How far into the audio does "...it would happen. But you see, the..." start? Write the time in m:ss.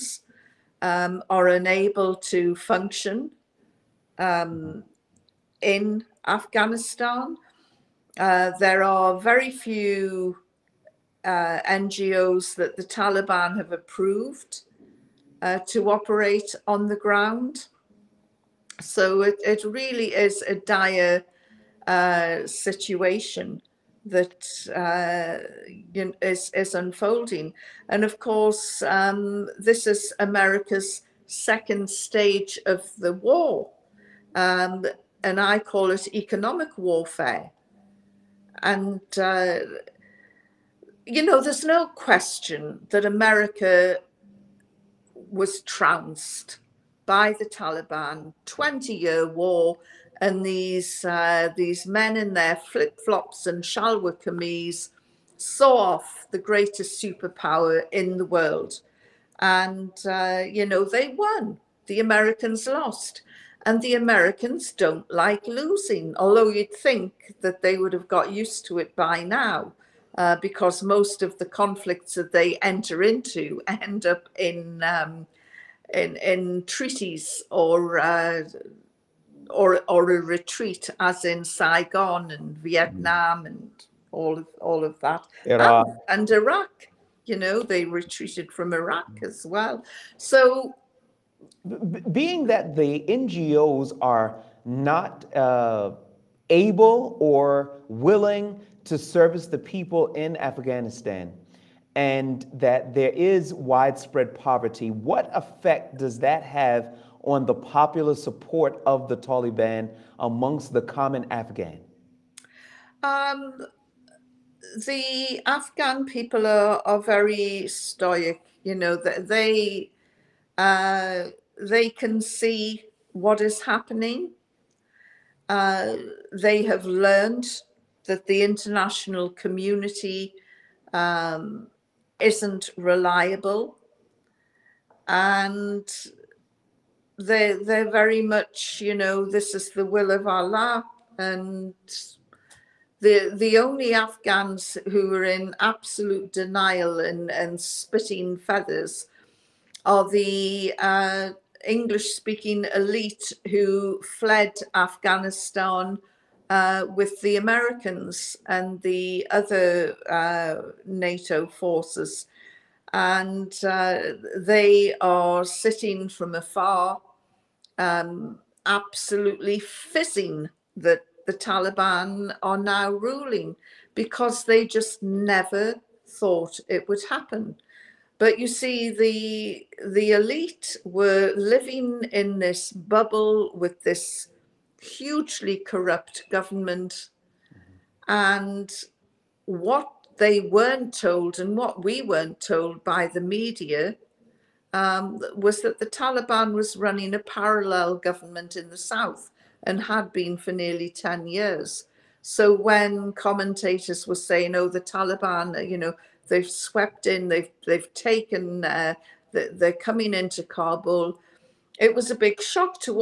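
2:56.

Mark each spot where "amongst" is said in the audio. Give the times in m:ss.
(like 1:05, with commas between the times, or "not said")
1:50.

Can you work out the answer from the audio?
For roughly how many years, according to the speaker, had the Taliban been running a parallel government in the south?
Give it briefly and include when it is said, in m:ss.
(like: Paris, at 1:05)
10, at 3:20.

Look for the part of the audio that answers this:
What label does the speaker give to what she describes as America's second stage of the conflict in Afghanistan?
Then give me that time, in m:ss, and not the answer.
0:36.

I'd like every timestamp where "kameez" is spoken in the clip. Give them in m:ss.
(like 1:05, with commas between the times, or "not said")
0:54.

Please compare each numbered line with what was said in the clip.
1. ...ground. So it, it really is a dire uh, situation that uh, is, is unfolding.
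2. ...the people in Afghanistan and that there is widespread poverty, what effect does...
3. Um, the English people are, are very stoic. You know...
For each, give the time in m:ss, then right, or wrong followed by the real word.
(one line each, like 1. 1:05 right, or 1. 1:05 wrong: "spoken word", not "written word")
1. 0:16 right
2. 1:39 right
3. 1:53 wrong: "Afghan", not "English".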